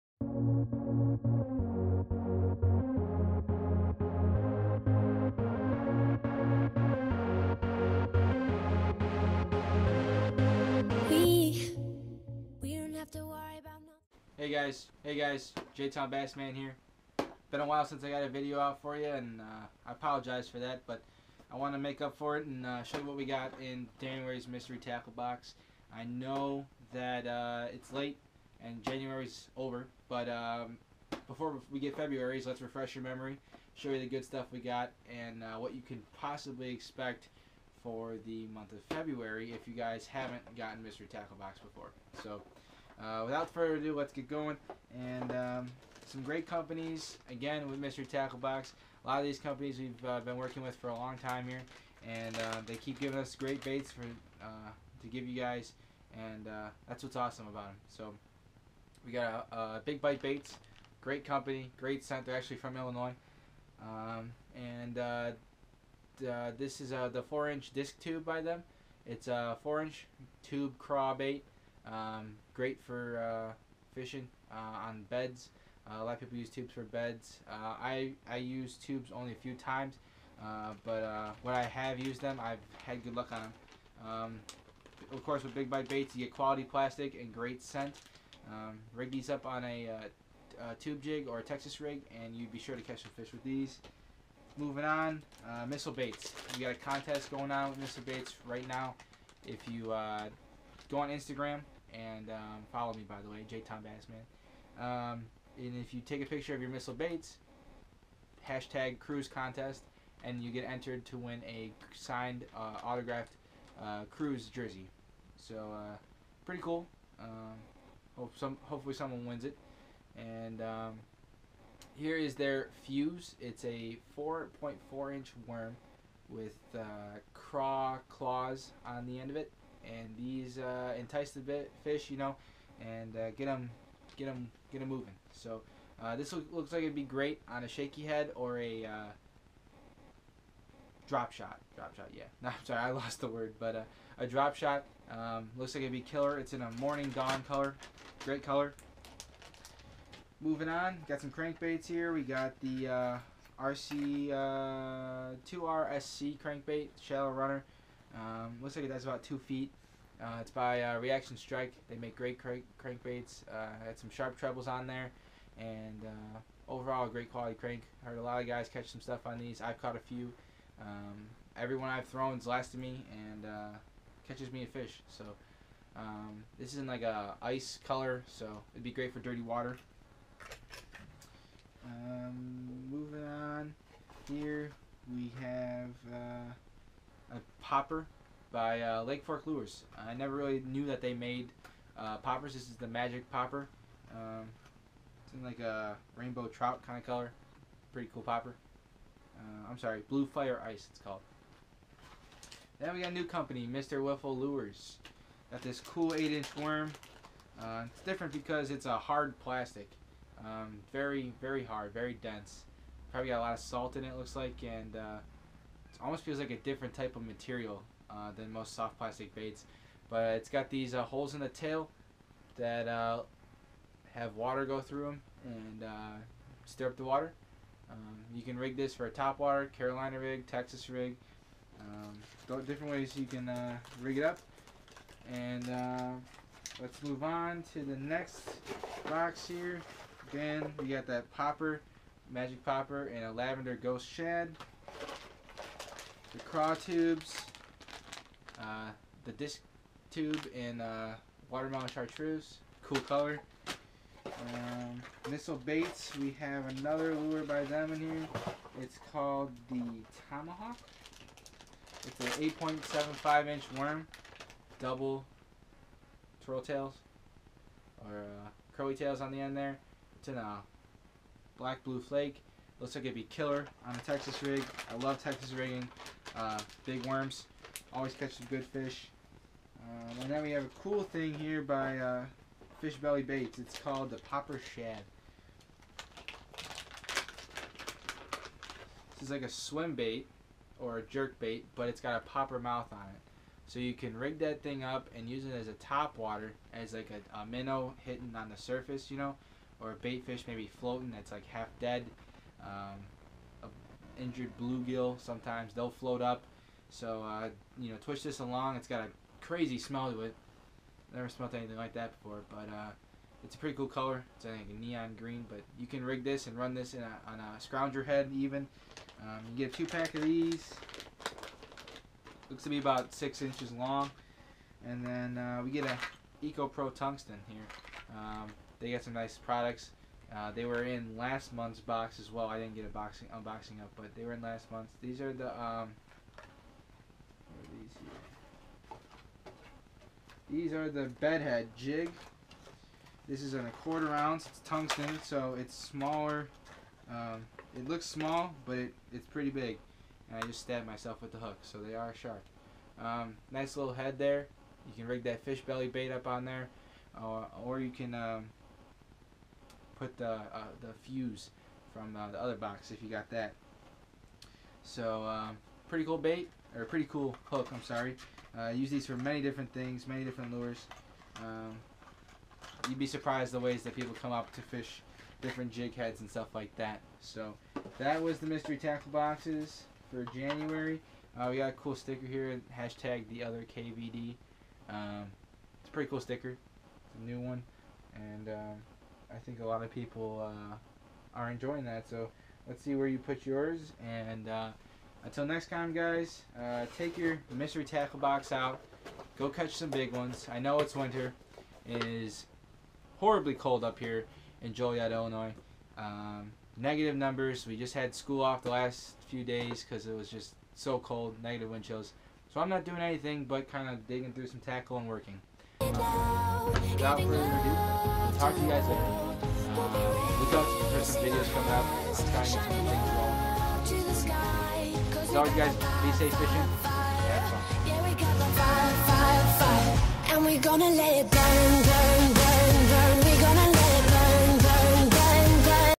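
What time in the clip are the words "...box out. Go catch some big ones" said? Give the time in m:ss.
6:38.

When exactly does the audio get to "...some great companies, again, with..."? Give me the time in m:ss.
0:46.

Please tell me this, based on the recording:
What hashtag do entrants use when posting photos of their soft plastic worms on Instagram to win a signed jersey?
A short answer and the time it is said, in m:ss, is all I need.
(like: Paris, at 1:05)
Crews contest, at 1:48.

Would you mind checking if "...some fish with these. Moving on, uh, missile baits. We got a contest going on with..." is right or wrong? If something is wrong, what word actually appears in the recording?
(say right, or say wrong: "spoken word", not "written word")
right.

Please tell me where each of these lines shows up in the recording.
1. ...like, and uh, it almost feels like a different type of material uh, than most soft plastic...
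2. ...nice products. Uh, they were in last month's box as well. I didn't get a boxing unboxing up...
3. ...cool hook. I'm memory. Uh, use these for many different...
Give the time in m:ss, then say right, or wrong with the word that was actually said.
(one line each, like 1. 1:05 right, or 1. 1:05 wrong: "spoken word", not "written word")
1. 3:34 right
2. 5:29 right
3. 6:07 wrong: "sorry", not "memory".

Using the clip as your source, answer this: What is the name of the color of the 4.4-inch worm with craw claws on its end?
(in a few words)
morning dawn.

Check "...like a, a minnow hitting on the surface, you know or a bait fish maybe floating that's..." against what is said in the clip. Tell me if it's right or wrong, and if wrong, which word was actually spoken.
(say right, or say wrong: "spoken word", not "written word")
right.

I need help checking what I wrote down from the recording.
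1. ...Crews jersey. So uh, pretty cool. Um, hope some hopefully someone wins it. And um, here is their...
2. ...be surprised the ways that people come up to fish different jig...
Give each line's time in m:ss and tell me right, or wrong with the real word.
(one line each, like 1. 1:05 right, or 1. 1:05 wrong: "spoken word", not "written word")
1. 1:54 right
2. 6:12 right.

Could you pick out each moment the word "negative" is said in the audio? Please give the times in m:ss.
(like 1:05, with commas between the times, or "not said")
6:46, 6:51.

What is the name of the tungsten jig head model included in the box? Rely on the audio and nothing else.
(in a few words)
bedhead jig.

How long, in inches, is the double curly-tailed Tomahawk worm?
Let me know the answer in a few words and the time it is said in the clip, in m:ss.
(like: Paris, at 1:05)
8.75 inches, at 4:22.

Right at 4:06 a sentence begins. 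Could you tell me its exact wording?
The craw tubes, uh, the disc tube, and uh, watermelon chartreuse.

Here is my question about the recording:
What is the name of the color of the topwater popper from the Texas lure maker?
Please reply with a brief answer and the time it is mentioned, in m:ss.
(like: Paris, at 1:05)
Blue Fire Ice, at 3:20.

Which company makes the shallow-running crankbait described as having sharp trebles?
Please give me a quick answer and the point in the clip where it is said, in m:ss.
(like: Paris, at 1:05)
Reaction Strike, at 2:40.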